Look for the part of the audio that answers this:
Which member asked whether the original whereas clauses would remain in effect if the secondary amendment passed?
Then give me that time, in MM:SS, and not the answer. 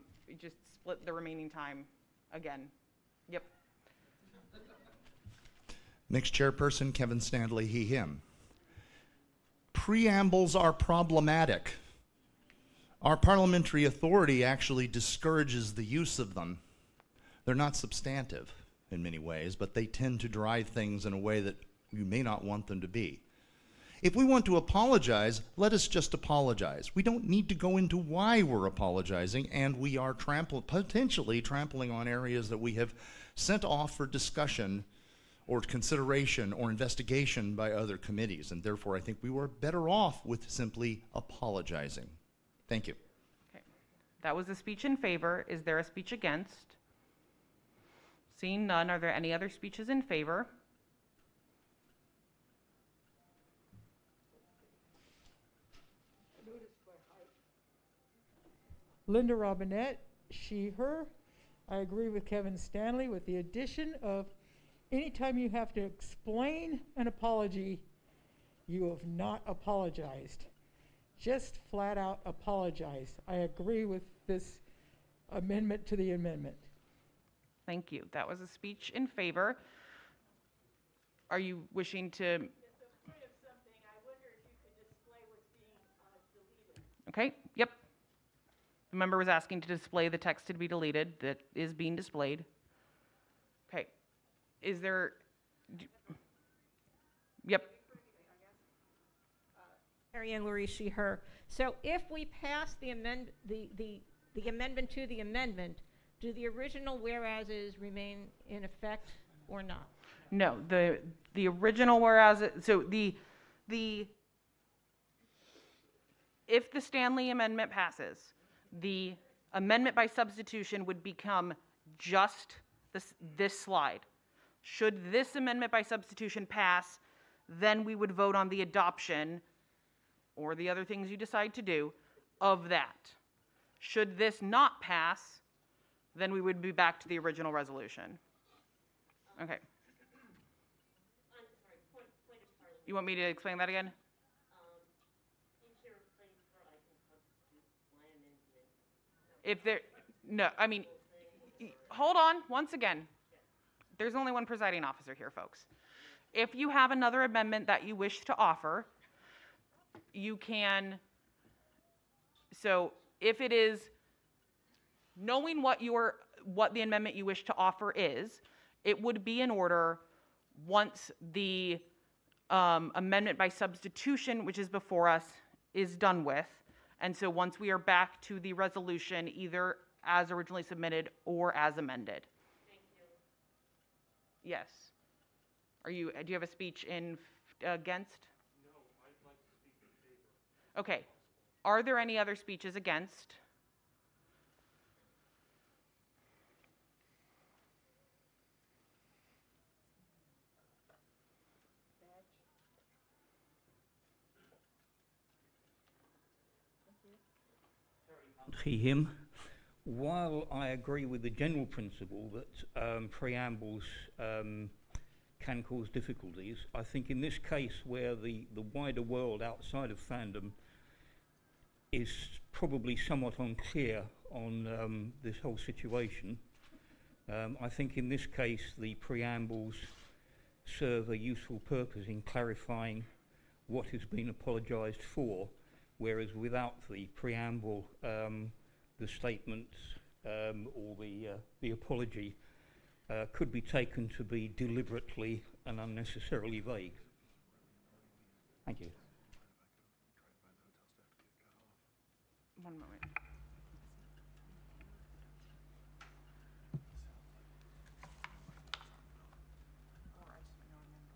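01:40.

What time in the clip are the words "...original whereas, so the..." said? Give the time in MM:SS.
01:51.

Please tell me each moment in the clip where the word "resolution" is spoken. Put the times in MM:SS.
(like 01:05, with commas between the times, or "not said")
02:17, 02:58.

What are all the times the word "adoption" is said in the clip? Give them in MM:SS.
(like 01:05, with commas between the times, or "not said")
02:08.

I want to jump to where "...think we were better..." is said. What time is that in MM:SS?
00:38.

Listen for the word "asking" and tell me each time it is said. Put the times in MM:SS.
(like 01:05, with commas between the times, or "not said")
01:29.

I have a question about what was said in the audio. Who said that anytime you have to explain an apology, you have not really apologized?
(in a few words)
Linda Robinette.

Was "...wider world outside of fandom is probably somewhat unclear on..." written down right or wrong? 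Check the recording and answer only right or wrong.
right.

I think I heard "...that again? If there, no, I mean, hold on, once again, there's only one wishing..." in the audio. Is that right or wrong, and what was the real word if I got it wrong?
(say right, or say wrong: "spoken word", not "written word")
wrong: "presiding", not "wishing".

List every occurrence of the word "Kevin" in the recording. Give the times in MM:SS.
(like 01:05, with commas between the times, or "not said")
00:06, 01:02.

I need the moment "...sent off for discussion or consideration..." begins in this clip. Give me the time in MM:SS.
00:33.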